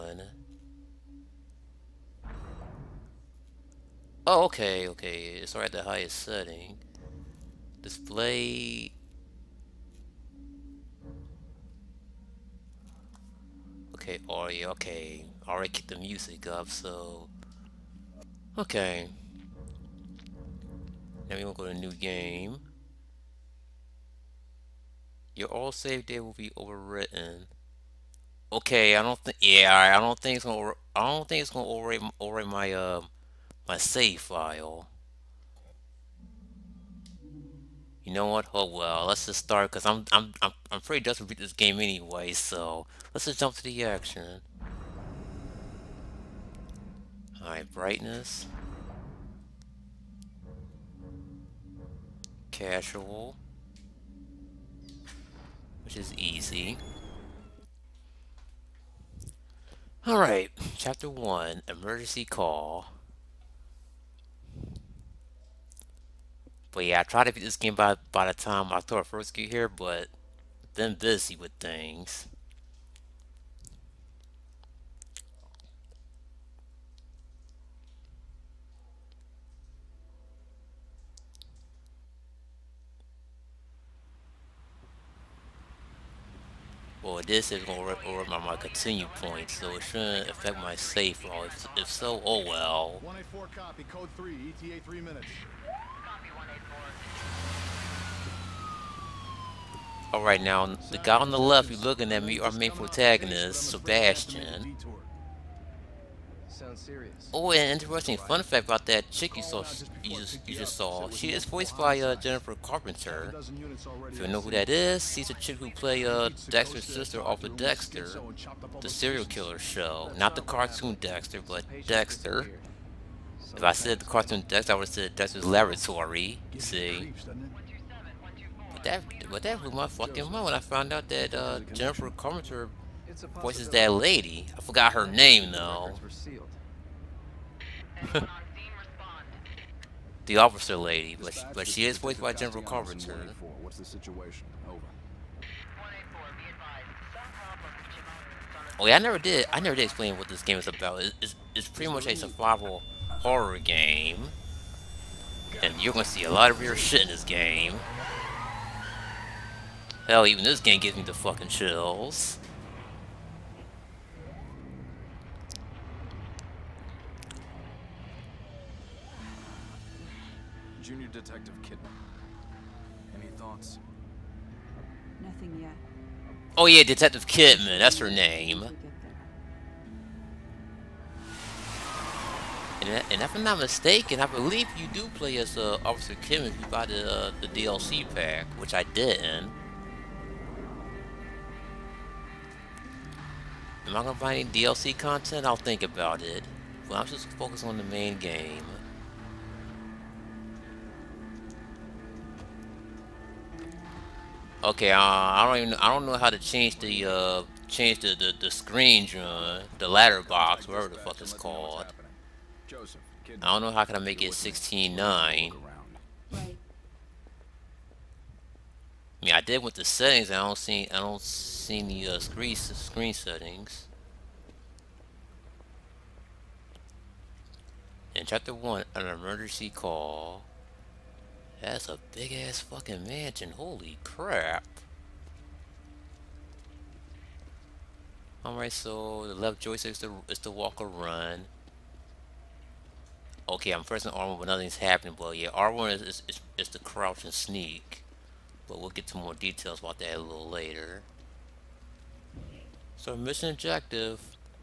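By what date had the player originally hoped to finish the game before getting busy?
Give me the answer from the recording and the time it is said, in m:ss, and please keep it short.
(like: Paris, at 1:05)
October 1, at 1:08.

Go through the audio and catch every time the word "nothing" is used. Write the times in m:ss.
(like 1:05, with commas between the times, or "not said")
2:55, 4:04.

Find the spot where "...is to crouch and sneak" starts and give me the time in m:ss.
4:06.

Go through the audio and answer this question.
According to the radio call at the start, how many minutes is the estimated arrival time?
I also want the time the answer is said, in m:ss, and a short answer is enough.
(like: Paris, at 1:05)
3, at 1:34.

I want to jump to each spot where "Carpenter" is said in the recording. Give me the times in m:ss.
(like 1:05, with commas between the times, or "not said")
1:52, 2:12, 2:22.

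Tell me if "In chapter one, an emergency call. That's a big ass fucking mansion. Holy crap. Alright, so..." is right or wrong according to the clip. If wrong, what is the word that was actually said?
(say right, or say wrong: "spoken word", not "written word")
right.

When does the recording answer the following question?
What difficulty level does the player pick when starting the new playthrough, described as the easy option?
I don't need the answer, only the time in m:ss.
0:52.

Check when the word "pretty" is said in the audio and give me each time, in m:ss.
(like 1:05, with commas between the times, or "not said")
0:40, 2:31.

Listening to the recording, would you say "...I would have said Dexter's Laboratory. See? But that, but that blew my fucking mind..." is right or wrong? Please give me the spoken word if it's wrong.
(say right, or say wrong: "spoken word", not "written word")
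right.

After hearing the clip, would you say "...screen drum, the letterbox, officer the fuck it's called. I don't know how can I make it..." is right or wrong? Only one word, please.
wrong.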